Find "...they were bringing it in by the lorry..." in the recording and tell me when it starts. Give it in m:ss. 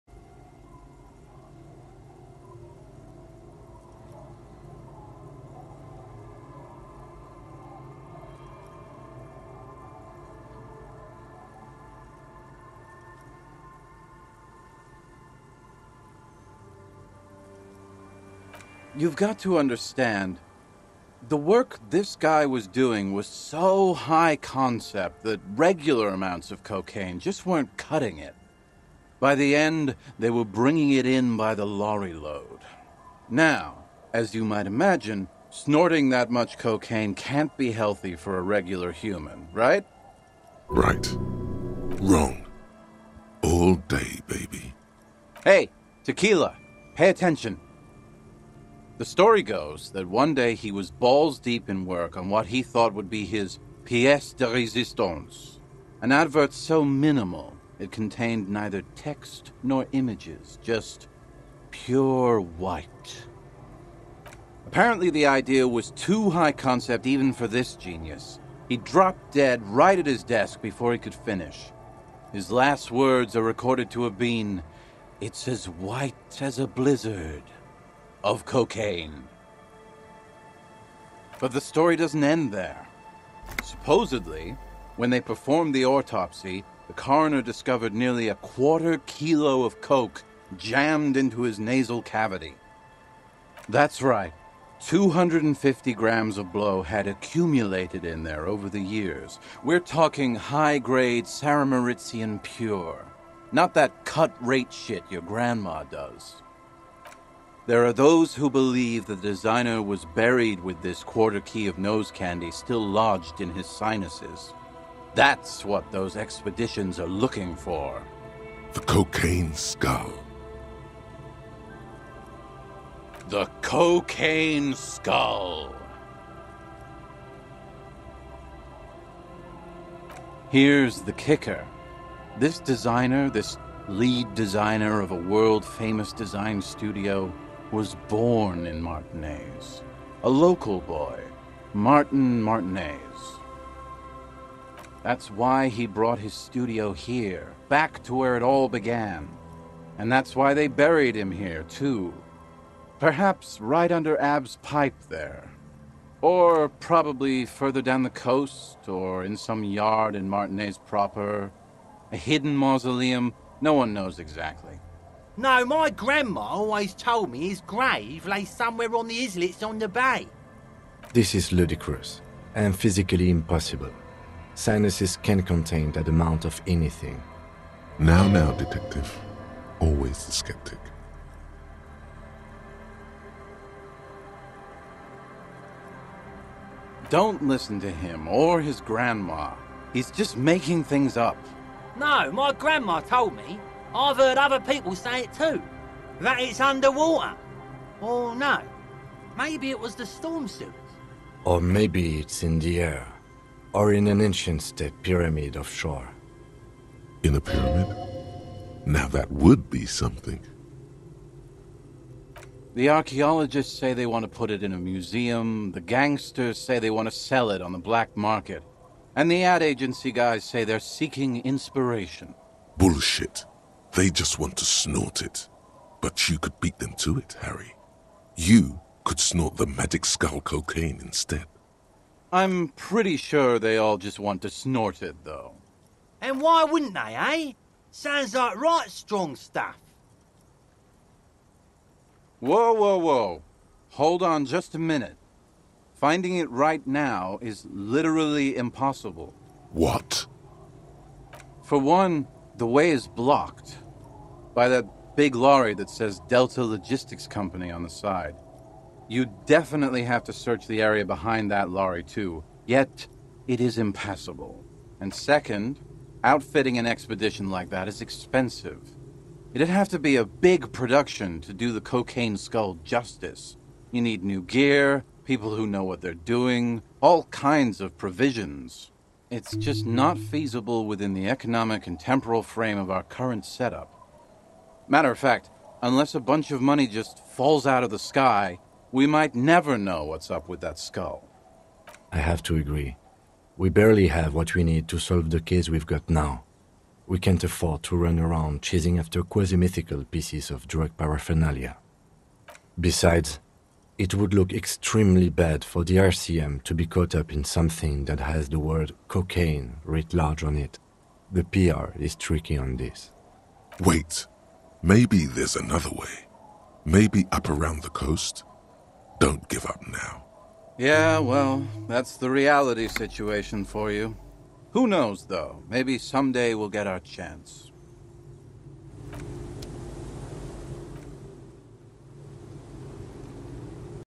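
0:30.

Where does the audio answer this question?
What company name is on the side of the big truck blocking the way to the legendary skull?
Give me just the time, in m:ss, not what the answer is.
4:16.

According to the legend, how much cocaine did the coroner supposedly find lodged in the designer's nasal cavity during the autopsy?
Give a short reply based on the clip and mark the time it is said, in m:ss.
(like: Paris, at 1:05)
250 grams, at 1:34.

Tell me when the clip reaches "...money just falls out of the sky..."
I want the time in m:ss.
4:46.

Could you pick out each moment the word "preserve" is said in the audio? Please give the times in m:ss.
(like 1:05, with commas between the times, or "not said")
not said.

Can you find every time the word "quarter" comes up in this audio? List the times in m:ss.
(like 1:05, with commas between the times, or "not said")
1:28, 1:51.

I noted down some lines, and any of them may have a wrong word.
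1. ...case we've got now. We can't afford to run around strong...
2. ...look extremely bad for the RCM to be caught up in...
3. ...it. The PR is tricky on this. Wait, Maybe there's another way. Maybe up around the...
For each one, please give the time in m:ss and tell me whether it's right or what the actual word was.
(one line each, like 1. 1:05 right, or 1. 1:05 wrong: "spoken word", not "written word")
1. 4:55 wrong: "chasing", not "strong"
2. 5:04 right
3. 5:10 right.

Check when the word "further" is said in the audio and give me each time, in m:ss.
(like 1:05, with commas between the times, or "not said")
2:37.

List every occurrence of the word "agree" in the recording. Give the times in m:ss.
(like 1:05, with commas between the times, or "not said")
4:52.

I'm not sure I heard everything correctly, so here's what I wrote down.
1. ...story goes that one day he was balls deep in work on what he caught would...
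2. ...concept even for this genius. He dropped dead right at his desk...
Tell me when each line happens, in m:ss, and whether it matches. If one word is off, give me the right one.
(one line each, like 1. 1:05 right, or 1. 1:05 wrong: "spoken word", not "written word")
1. 0:49 wrong: "thought", not "caught"
2. 1:06 right.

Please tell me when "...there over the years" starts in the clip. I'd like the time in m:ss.
1:38.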